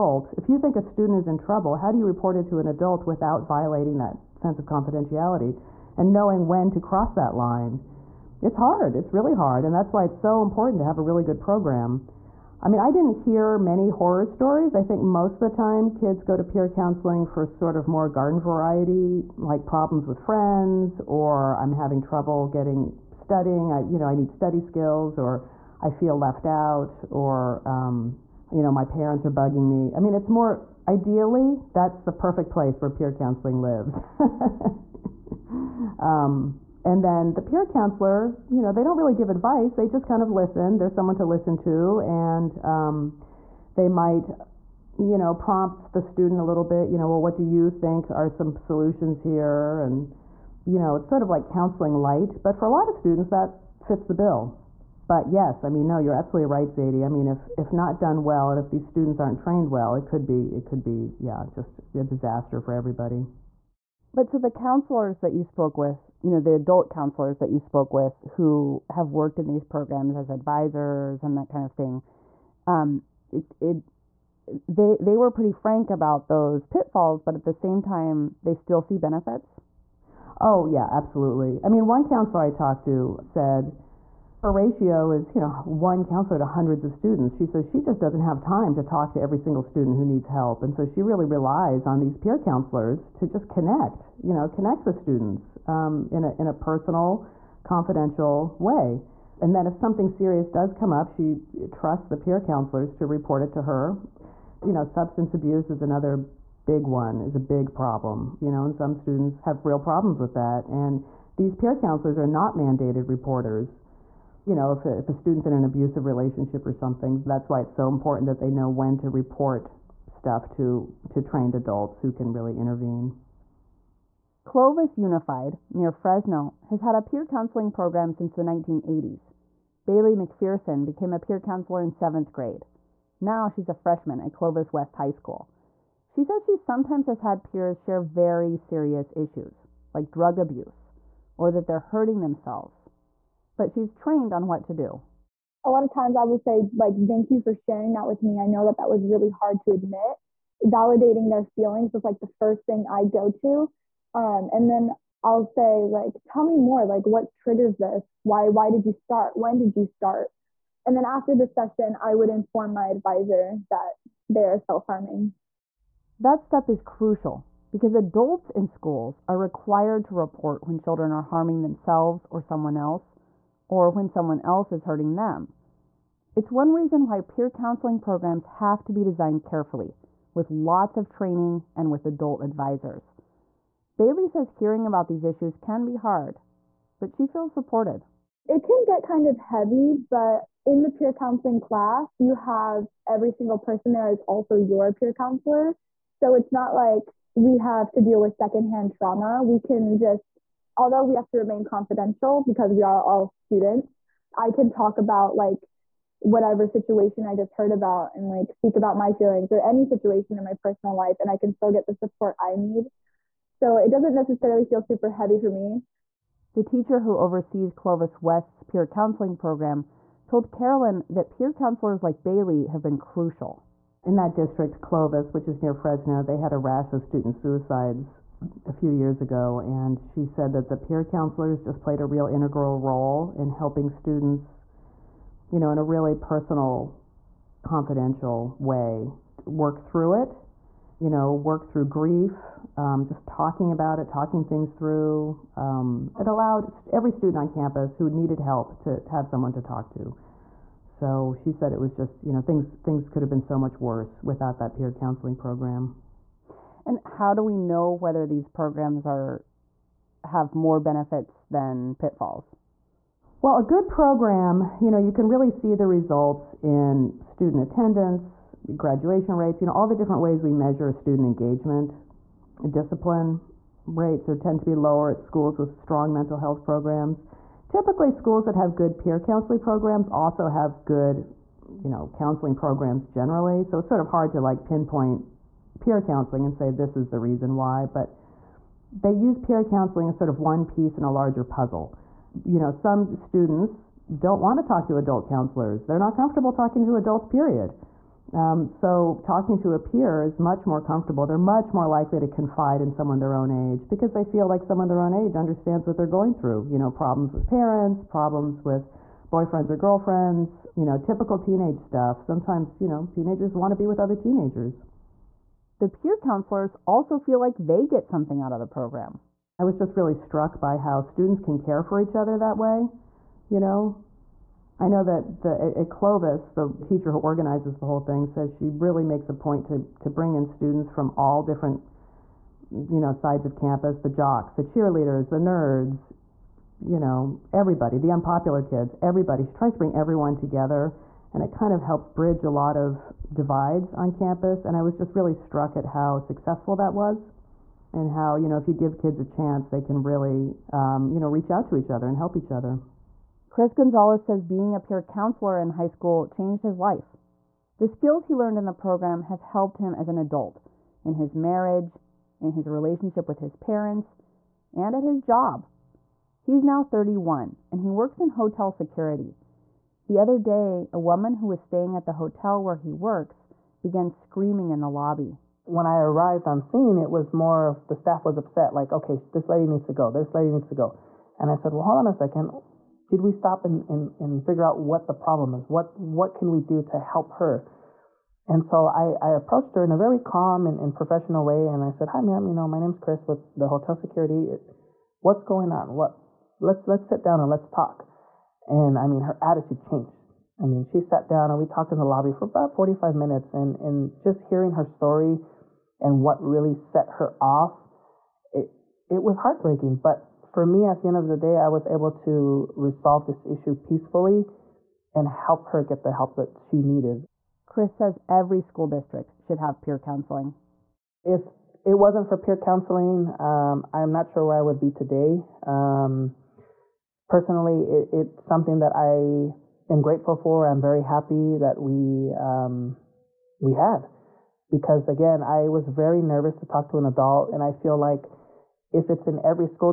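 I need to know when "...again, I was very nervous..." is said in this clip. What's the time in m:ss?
7:15.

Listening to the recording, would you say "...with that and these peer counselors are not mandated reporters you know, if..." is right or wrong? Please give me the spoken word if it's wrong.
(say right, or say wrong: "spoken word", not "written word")
right.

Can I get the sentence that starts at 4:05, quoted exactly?
Um, it allowed every student on campus who needed help to, to have someone to talk to.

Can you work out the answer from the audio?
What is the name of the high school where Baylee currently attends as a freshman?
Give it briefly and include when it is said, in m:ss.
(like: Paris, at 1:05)
Clovis West High School, at 2:14.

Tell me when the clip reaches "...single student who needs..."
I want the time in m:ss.
1:29.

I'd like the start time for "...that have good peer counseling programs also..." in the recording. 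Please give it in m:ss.
4:38.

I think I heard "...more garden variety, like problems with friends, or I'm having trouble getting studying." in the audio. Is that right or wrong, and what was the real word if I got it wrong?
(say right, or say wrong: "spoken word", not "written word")
right.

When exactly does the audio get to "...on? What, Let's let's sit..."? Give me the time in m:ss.
6:35.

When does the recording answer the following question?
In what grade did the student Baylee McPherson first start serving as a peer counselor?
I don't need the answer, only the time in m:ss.
2:11.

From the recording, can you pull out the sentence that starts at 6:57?
Chris says every school district should have peer counseling.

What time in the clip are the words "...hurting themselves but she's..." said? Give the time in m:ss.
2:21.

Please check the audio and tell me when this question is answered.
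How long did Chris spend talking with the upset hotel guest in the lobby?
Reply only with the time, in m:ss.
6:42.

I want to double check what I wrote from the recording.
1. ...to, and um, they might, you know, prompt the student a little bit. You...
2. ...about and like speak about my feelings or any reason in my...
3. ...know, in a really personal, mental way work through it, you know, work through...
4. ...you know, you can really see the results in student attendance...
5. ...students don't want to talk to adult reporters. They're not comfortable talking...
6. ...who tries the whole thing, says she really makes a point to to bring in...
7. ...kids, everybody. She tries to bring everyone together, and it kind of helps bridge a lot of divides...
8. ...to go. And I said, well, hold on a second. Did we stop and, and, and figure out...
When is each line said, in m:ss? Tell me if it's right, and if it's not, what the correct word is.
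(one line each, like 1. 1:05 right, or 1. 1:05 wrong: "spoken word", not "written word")
1. 0:41 right
2. 3:27 wrong: "situation", not "reason"
3. 3:55 wrong: "confidential", not "mental"
4. 4:24 right
5. 4:53 wrong: "counselors", not "reporters"
6. 5:27 wrong: "organizes", not "tries"
7. 5:38 right
8. 6:20 right.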